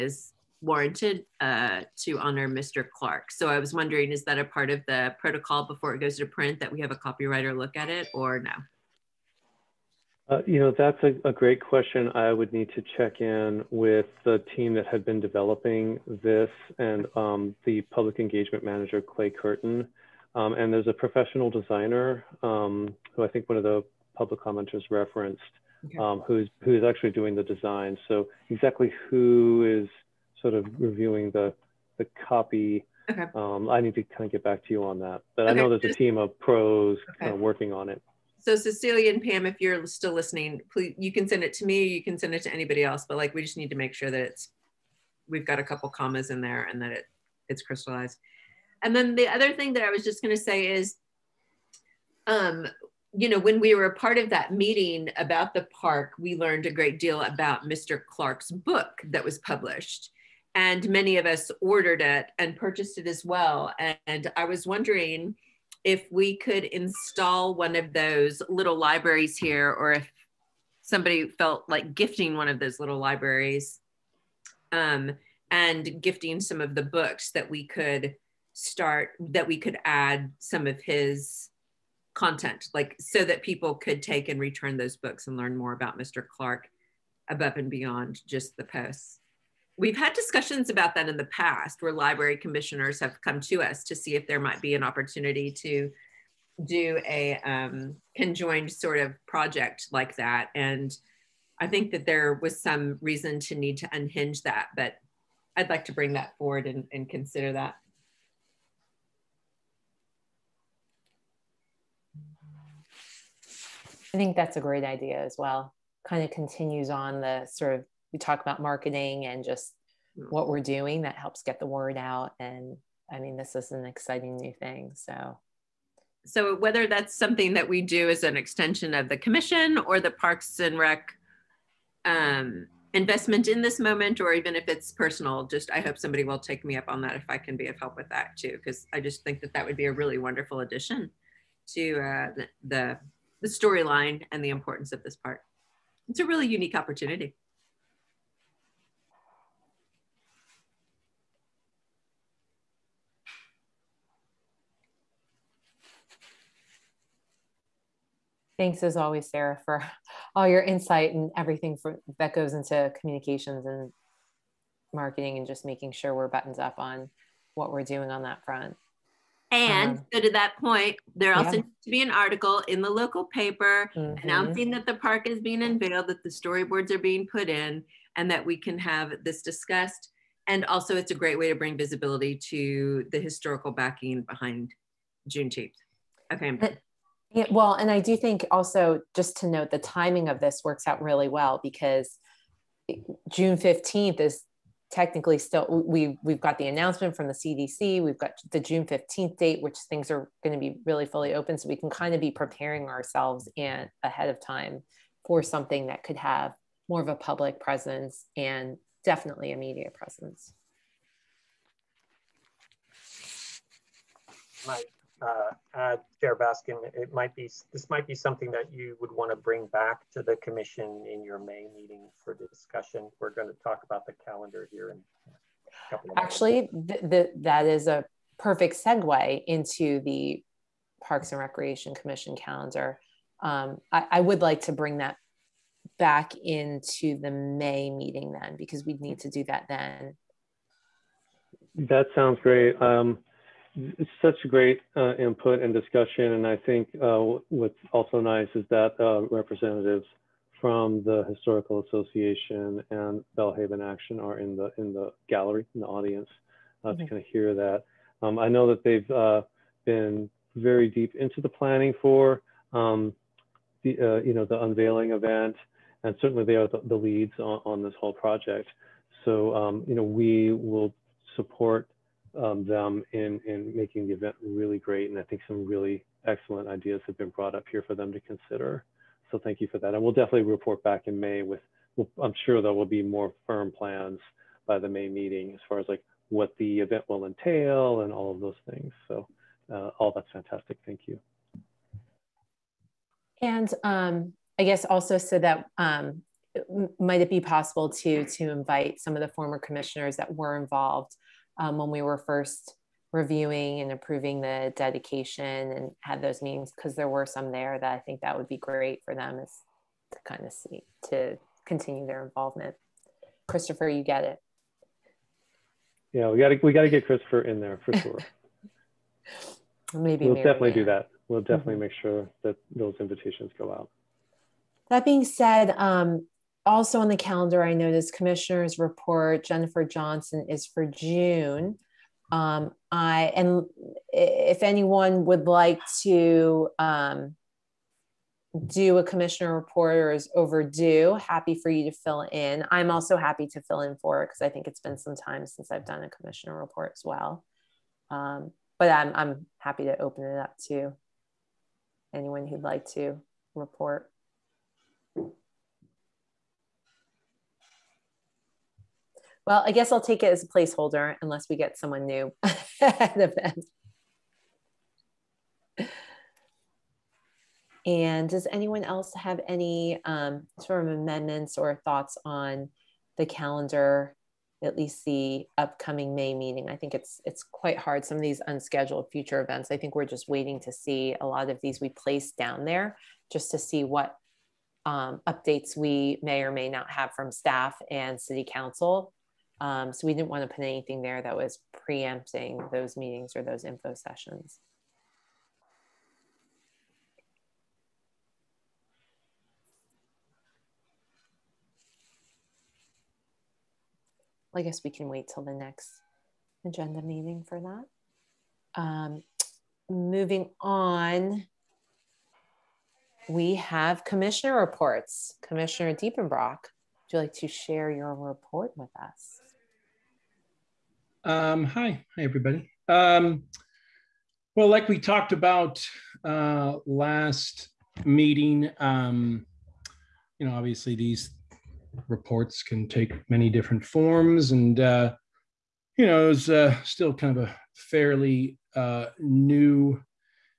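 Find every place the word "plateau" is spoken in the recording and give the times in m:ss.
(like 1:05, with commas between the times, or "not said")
not said.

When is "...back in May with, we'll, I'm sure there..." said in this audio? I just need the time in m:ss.
4:40.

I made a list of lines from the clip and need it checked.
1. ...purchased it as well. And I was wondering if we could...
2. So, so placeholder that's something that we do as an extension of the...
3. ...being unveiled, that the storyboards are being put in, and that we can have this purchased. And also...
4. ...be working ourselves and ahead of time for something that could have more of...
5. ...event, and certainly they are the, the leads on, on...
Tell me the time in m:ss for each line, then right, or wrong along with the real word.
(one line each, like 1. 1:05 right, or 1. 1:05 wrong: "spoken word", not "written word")
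1. 1:02 right
2. 2:04 wrong: "whether", not "placeholder"
3. 2:55 wrong: "discussed", not "purchased"
4. 3:22 wrong: "preparing", not "working"
5. 4:25 right.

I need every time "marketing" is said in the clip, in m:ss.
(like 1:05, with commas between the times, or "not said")
1:58, 2:44.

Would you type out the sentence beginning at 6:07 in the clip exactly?
And does anyone else have any um, sort of amendments or thoughts on the calendar, at least the upcoming May meeting?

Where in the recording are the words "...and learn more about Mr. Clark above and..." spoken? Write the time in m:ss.
1:25.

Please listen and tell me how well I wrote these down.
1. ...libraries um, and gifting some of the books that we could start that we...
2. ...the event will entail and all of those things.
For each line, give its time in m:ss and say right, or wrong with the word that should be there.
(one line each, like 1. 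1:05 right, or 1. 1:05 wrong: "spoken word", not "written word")
1. 1:12 right
2. 4:46 right.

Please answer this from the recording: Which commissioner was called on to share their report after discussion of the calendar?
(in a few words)
Commissioner Diepenbrock.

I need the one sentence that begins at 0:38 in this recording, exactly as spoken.
So Cecilia and Pam, if you're still listening, please you can send it to me.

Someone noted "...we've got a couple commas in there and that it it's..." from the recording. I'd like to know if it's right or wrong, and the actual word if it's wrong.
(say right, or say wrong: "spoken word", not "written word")
right.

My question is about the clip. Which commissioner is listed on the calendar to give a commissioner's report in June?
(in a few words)
Jennifer Johnson.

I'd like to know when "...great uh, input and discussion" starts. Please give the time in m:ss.
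4:04.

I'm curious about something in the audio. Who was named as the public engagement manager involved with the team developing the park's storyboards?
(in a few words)
Clay Curtin.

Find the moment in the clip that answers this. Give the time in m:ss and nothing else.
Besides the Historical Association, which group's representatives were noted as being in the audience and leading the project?
4:13.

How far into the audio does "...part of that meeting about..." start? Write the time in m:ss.
0:53.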